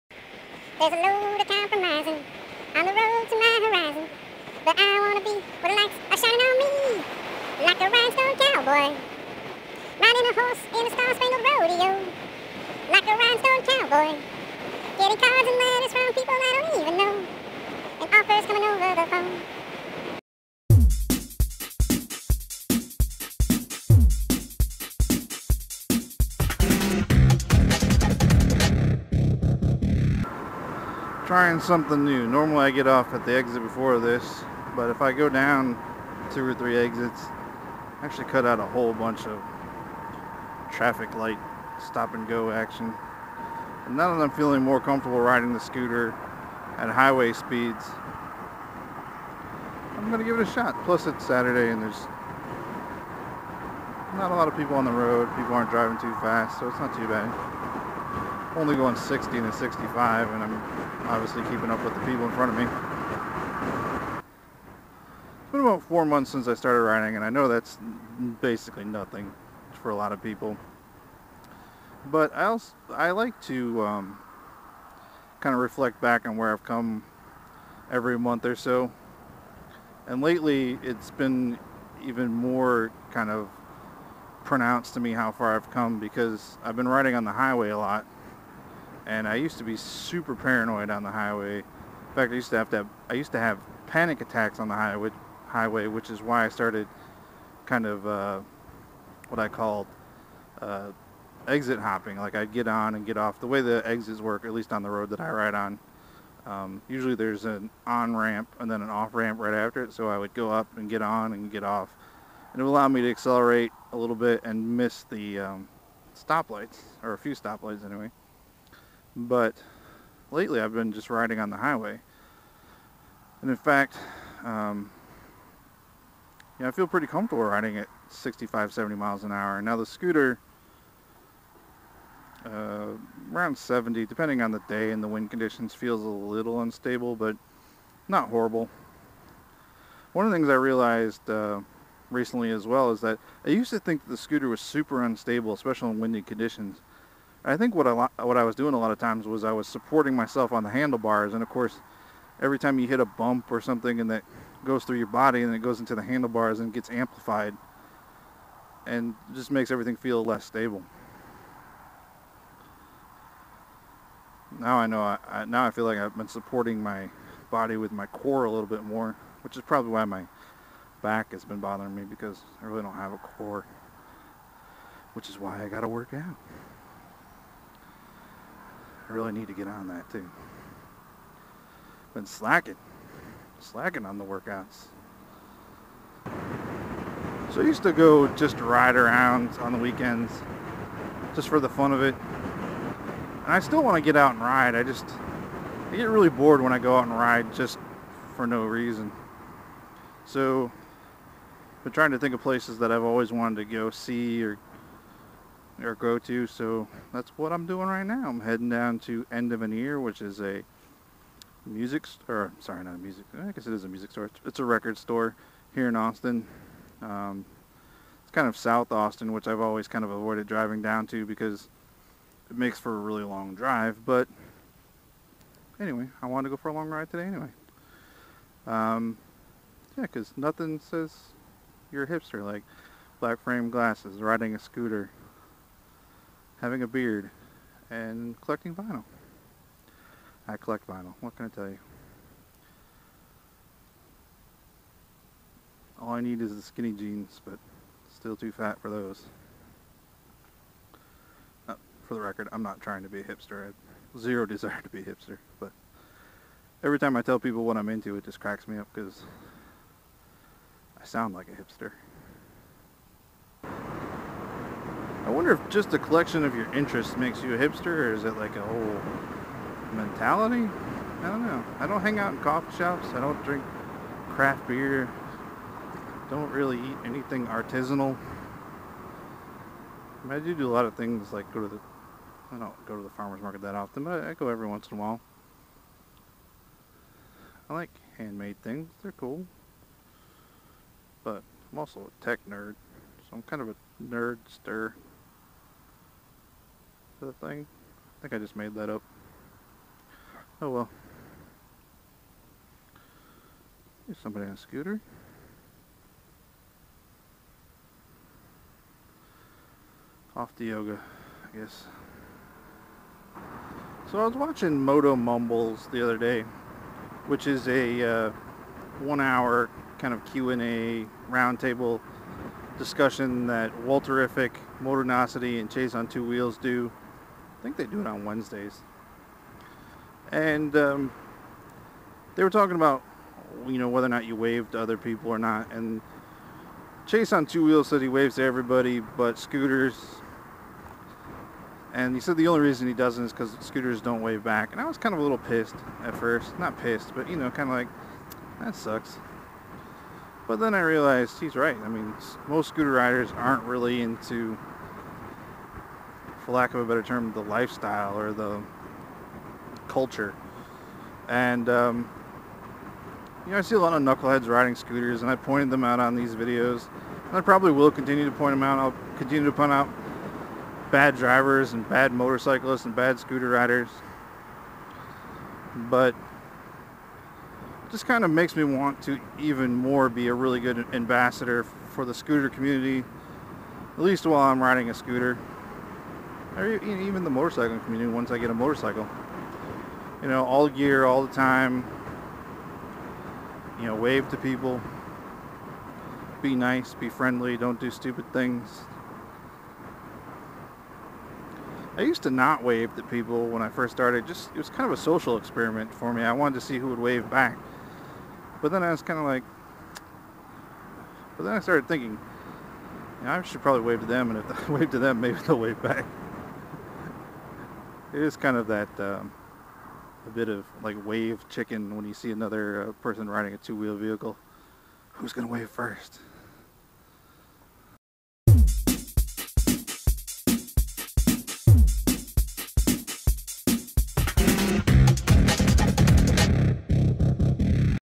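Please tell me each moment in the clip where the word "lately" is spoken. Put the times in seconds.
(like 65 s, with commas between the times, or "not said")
80 s, 120 s.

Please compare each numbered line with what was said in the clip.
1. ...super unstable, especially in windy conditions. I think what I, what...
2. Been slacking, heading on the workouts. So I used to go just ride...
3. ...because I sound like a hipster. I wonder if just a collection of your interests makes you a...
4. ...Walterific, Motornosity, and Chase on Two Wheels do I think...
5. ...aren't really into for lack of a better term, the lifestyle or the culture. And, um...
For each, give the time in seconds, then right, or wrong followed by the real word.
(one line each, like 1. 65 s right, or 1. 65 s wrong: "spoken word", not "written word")
1. 144 s right
2. 182 s wrong: "slacking", not "heading"
3. 258 s right
4. 323 s right
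5. 353 s right.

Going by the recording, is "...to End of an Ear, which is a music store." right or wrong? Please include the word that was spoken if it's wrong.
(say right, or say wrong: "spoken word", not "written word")
right.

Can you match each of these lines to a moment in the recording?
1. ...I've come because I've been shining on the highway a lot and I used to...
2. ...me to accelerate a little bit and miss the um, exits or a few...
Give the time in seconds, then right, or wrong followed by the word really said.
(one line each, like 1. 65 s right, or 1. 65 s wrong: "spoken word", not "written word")
1. 85 s wrong: "riding", not "shining"
2. 112 s wrong: "stoplights", not "exits".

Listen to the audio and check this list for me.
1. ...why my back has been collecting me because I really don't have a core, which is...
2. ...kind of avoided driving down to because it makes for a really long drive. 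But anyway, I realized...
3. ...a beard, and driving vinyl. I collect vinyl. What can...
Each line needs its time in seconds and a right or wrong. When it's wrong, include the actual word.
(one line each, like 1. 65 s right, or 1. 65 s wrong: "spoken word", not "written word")
1. 169 s wrong: "bothering", not "collecting"
2. 219 s wrong: "wanted", not "realized"
3. 236 s wrong: "collecting", not "driving".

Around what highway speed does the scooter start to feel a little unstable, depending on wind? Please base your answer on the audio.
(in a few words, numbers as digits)
70.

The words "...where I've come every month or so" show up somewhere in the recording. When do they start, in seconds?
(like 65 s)
76 s.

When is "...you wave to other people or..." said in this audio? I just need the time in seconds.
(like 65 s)
334 s.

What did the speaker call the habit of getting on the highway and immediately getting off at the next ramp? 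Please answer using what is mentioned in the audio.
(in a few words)
exit hopping.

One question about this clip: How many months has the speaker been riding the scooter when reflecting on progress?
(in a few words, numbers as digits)
4.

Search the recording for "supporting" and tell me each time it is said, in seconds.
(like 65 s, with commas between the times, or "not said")
149 s, 166 s.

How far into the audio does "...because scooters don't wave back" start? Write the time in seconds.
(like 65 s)
343 s.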